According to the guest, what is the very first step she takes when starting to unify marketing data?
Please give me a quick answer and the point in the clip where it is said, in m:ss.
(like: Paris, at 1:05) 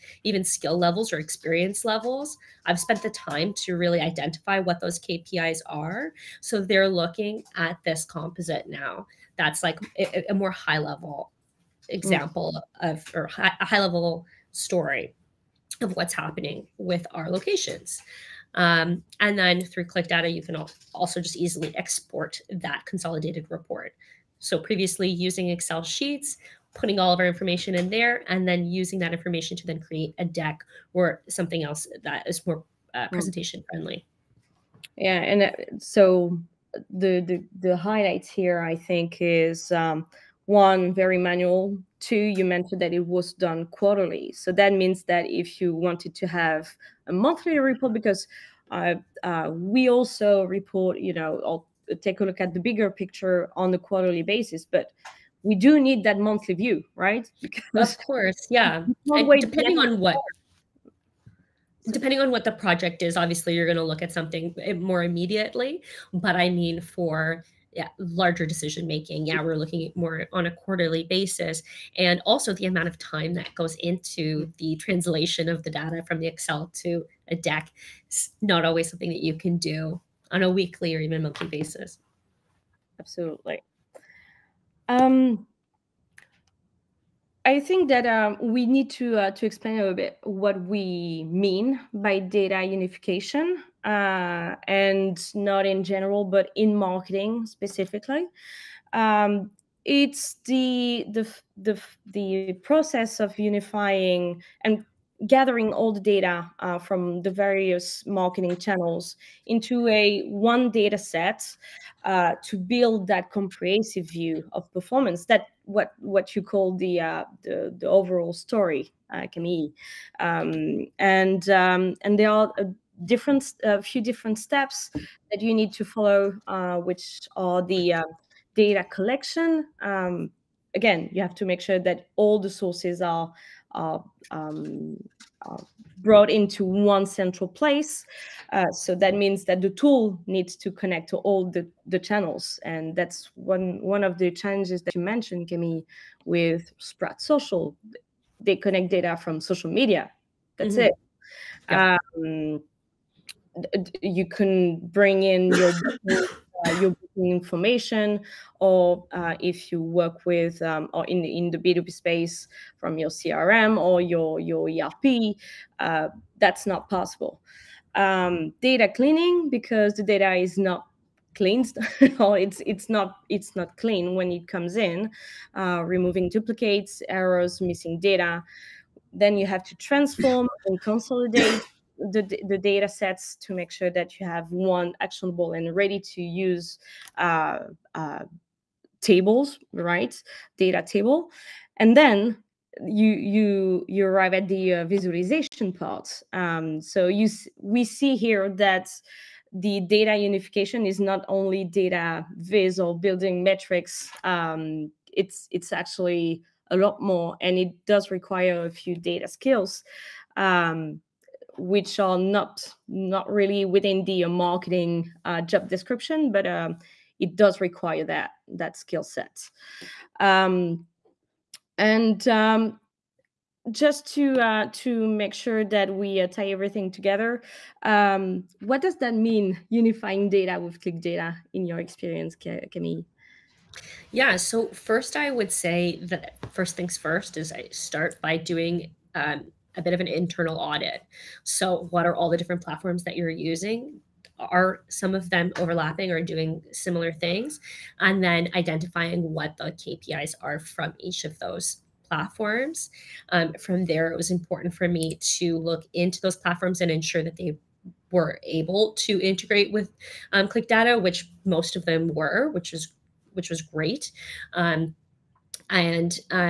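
An internal audit, at 4:00.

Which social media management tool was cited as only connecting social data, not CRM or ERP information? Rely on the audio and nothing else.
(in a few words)
Sprout Social.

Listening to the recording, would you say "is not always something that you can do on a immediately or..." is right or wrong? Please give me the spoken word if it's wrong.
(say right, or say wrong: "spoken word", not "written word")
wrong: "weekly", not "immediately".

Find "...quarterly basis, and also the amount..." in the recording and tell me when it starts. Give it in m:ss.
1:10.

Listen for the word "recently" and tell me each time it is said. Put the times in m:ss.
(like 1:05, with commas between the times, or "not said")
not said.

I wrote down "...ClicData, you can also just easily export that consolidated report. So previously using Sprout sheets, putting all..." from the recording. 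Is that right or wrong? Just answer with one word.
wrong.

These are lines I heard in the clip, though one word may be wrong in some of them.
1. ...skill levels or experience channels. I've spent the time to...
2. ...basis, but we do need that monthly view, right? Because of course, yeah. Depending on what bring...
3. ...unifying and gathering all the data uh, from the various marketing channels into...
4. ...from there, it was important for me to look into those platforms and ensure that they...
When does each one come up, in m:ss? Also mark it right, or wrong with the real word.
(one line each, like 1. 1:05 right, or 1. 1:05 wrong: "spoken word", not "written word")
1. 0:00 wrong: "levels", not "channels"
2. 0:54 wrong: "depending", not "bring"
3. 1:43 right
4. 4:13 right.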